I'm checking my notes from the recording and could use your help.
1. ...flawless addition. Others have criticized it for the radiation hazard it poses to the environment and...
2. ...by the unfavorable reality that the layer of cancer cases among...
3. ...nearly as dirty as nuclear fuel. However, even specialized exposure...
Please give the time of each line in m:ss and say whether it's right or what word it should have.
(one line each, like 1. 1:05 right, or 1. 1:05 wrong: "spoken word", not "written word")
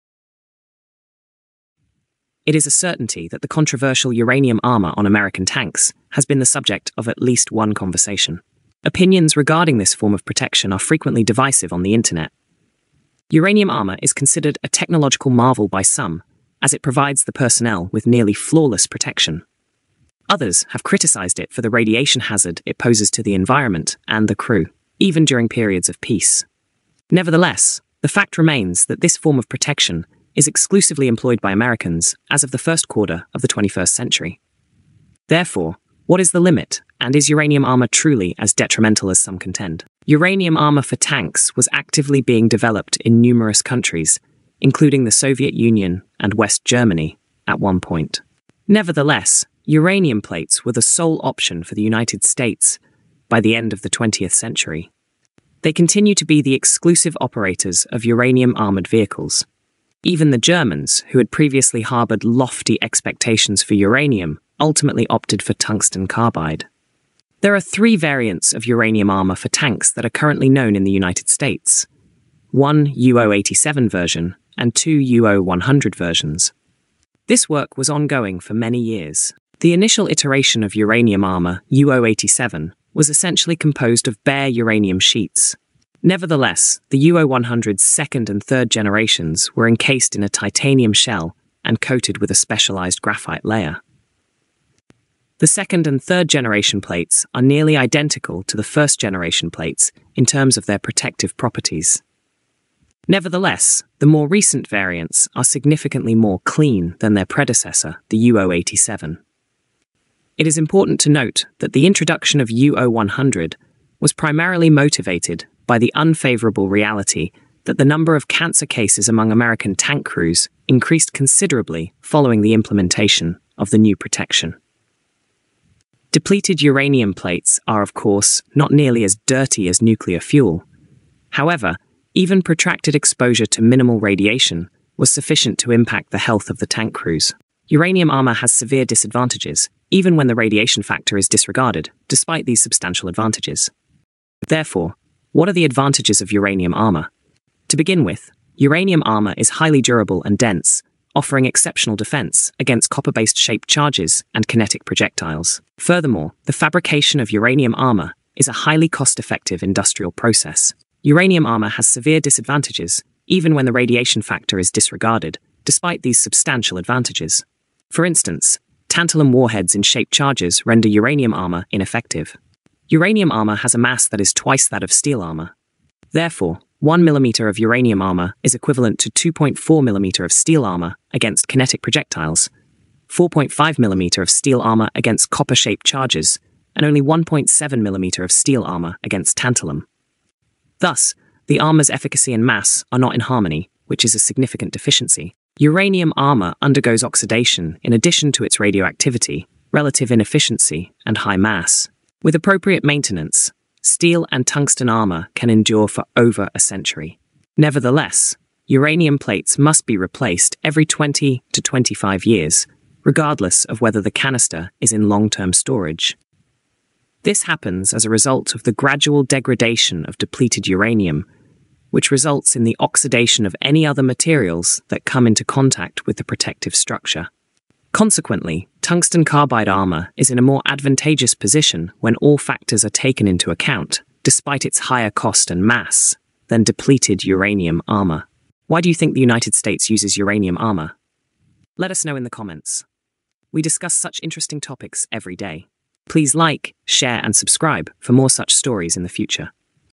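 1. 0:18 wrong: "protection", not "addition"
2. 1:55 wrong: "number", not "layer"
3. 2:08 wrong: "protracted", not "specialized".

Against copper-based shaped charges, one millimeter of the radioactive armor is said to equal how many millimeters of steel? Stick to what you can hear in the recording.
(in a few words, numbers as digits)
4.5.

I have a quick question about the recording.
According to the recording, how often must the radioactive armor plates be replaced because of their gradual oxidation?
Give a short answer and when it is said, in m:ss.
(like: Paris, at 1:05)
every 20 to 25 years, at 3:30.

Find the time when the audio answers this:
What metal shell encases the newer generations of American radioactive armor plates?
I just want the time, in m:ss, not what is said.
1:30.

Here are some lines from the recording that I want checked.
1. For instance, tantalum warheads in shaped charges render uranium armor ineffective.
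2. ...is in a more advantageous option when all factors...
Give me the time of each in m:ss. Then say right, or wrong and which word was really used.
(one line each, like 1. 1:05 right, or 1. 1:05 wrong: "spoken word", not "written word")
1. 2:47 right
2. 3:50 wrong: "position", not "option".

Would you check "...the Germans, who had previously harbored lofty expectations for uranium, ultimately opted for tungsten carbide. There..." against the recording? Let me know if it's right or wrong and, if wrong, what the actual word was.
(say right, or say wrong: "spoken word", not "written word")
right.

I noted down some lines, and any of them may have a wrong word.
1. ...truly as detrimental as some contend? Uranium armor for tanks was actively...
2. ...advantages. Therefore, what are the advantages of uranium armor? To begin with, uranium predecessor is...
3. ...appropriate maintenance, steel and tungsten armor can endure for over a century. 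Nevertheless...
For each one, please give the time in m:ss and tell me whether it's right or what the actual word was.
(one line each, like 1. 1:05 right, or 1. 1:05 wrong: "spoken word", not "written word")
1. 0:37 right
2. 2:23 wrong: "armor", not "predecessor"
3. 3:22 right.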